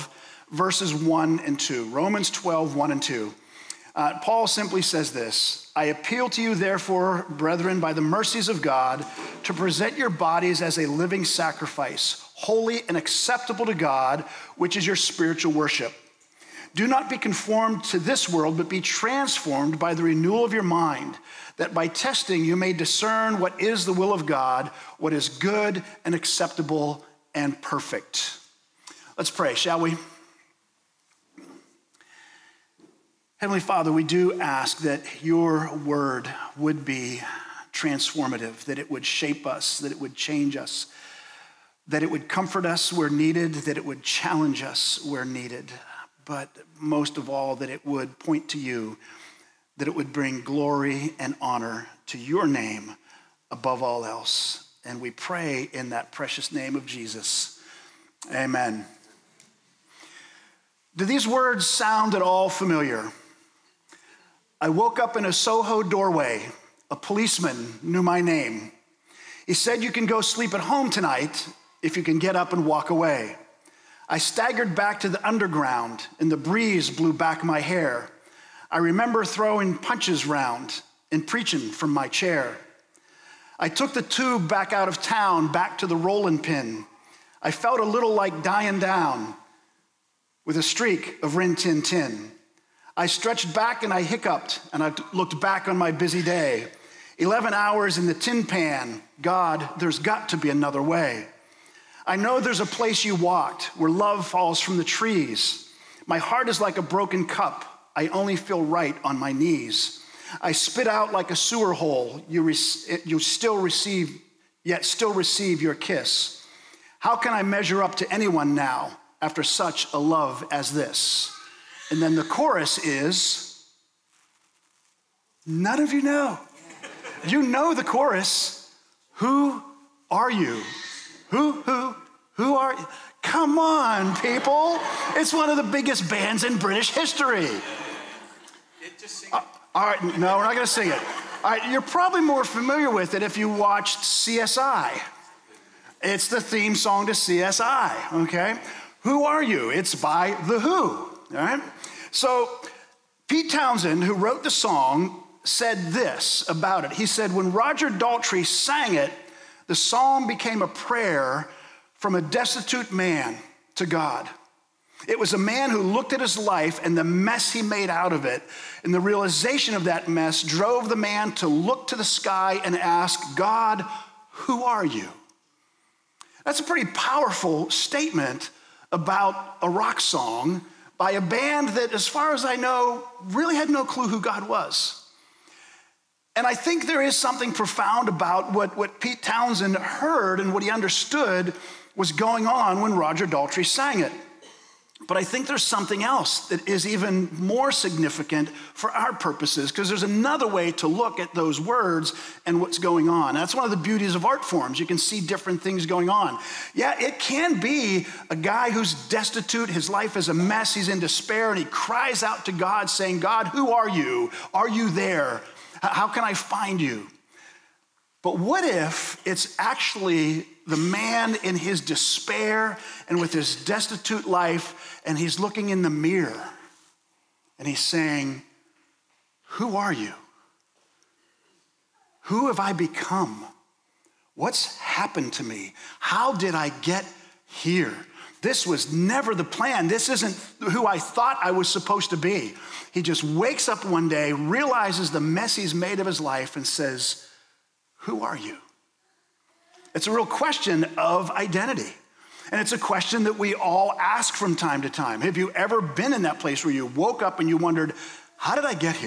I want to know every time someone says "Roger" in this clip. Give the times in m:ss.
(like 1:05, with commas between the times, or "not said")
2:37, 3:12.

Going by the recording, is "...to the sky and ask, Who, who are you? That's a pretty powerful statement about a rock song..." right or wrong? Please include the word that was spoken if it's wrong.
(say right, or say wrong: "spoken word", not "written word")
wrong: "God", not "Who".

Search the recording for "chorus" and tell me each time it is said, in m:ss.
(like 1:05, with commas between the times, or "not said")
2:02, 2:07.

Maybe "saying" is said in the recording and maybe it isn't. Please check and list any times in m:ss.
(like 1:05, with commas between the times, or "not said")
3:32, 3:47.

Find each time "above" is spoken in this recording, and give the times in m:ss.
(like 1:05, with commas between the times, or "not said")
0:53.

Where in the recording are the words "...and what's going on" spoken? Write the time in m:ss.
3:22.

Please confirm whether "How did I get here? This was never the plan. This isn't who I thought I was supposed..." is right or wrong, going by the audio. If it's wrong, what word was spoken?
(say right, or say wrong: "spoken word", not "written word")
right.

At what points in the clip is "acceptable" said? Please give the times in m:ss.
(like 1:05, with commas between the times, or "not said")
0:12, 0:26.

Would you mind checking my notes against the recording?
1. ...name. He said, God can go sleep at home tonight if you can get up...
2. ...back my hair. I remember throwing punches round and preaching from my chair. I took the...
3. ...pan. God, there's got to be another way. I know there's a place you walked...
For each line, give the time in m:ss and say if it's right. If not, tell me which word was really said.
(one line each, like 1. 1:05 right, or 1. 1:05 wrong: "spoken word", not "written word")
1. 1:08 wrong: "You", not "God"
2. 1:17 right
3. 1:38 right.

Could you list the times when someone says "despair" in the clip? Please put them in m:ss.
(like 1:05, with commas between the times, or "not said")
3:30, 3:41.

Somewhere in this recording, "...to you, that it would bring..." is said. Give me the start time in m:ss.
0:48.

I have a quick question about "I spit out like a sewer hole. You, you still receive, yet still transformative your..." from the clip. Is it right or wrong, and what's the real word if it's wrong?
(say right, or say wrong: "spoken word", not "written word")
wrong: "receive", not "transformative".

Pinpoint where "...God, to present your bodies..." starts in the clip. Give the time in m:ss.
0:08.